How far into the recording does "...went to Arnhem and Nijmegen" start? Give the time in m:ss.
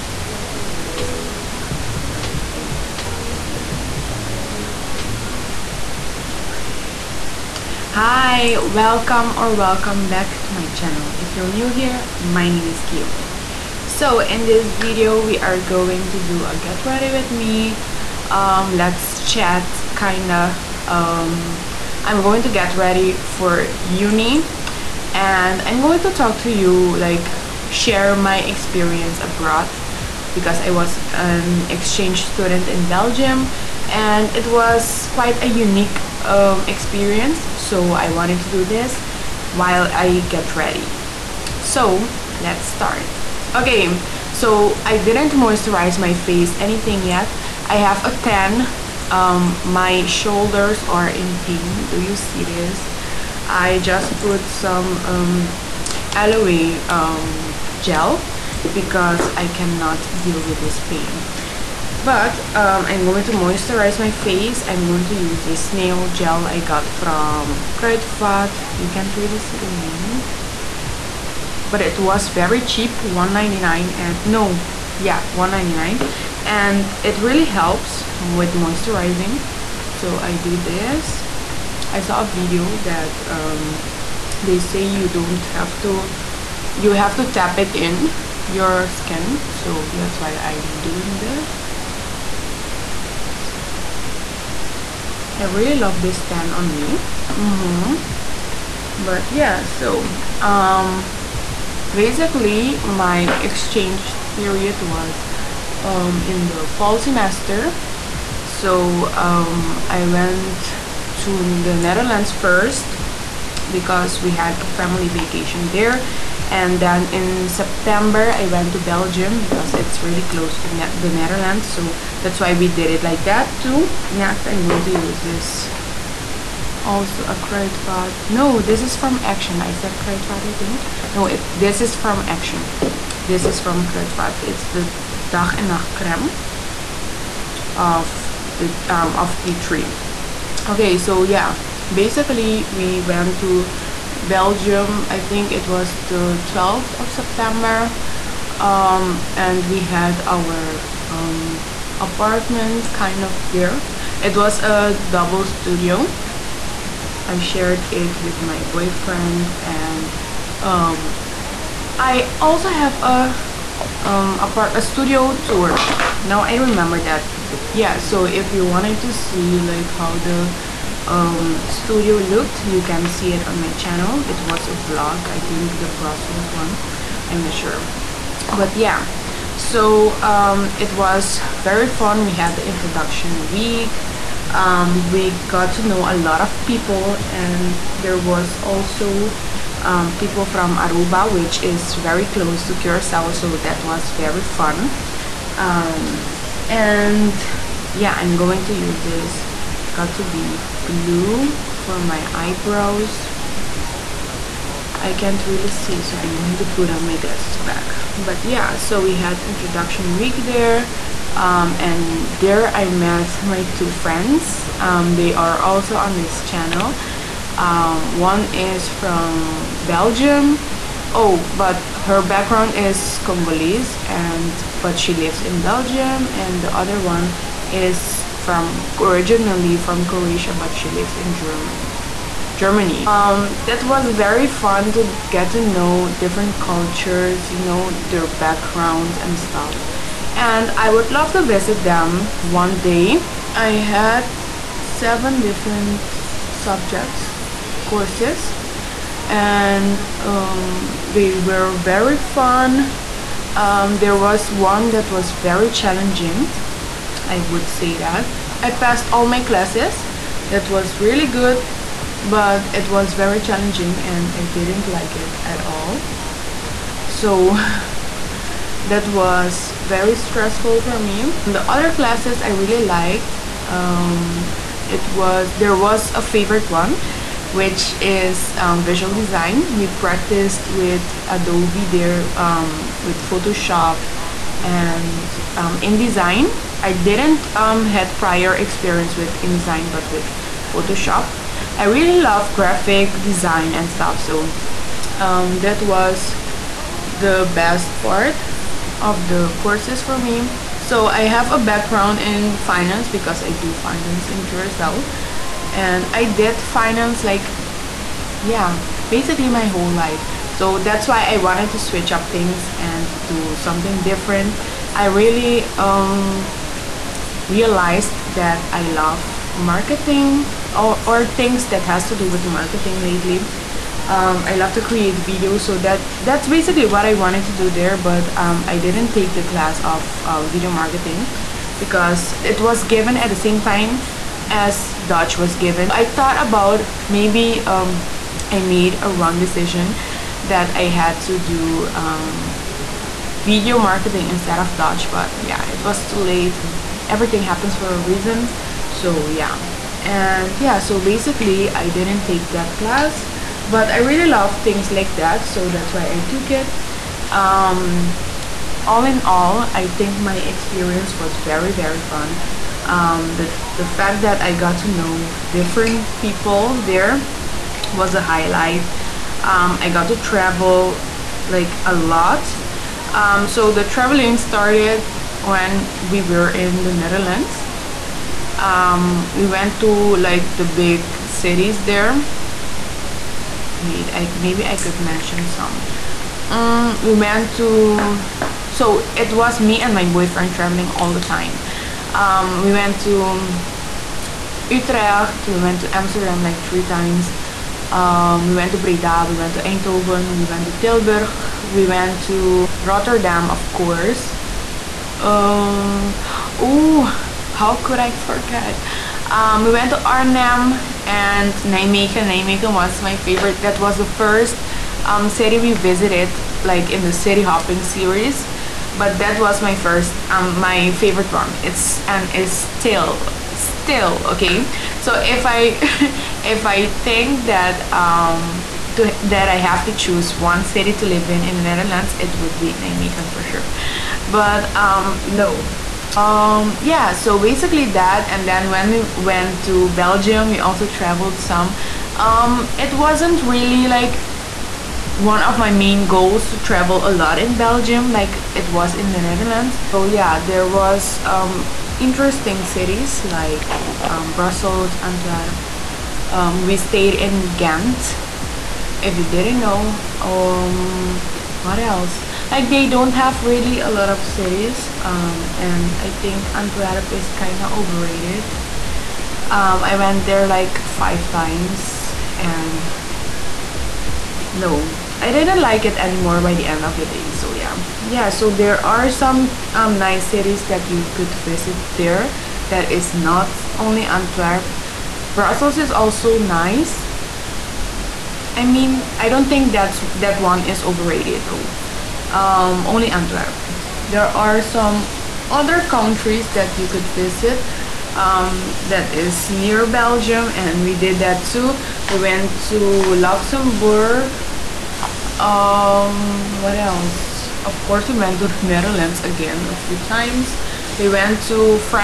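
6:49.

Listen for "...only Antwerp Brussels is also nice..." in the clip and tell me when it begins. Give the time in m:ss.
8:03.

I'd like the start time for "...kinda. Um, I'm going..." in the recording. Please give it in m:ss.
0:19.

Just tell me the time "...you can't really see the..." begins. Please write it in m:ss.
1:08.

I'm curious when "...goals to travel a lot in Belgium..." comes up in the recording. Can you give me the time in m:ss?
7:26.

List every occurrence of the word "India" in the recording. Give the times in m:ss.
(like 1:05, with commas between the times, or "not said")
not said.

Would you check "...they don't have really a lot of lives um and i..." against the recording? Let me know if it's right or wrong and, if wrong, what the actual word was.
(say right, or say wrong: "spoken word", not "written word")
wrong: "cities", not "lives".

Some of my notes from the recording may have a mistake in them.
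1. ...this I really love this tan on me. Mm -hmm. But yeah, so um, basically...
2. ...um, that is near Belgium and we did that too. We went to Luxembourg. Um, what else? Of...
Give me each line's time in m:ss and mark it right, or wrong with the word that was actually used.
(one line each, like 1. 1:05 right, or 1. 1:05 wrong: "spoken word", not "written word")
1. 1:31 right
2. 8:18 right.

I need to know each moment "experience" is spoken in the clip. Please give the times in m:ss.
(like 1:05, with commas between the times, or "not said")
0:28, 0:36, 4:48, 6:00.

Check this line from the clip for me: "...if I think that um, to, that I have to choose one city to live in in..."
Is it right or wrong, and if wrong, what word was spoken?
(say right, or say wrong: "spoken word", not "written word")
right.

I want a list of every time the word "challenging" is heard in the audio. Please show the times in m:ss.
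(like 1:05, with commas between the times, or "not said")
4:15, 4:23.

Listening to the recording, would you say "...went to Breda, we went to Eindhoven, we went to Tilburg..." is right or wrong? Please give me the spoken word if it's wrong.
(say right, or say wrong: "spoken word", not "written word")
right.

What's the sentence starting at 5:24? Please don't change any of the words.
Um, I love to create videos, so that that's basically what I wanted to do there.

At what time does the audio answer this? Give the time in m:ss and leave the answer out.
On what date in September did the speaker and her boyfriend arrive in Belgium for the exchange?
2:26.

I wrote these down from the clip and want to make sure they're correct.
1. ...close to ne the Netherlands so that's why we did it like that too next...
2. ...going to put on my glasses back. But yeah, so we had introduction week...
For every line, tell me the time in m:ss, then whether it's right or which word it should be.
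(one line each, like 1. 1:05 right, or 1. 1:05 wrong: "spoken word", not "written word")
1. 2:00 right
2. 3:26 right.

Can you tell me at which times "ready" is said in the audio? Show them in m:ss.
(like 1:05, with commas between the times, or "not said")
0:16, 0:22, 0:40.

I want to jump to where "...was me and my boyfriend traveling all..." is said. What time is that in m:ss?
6:29.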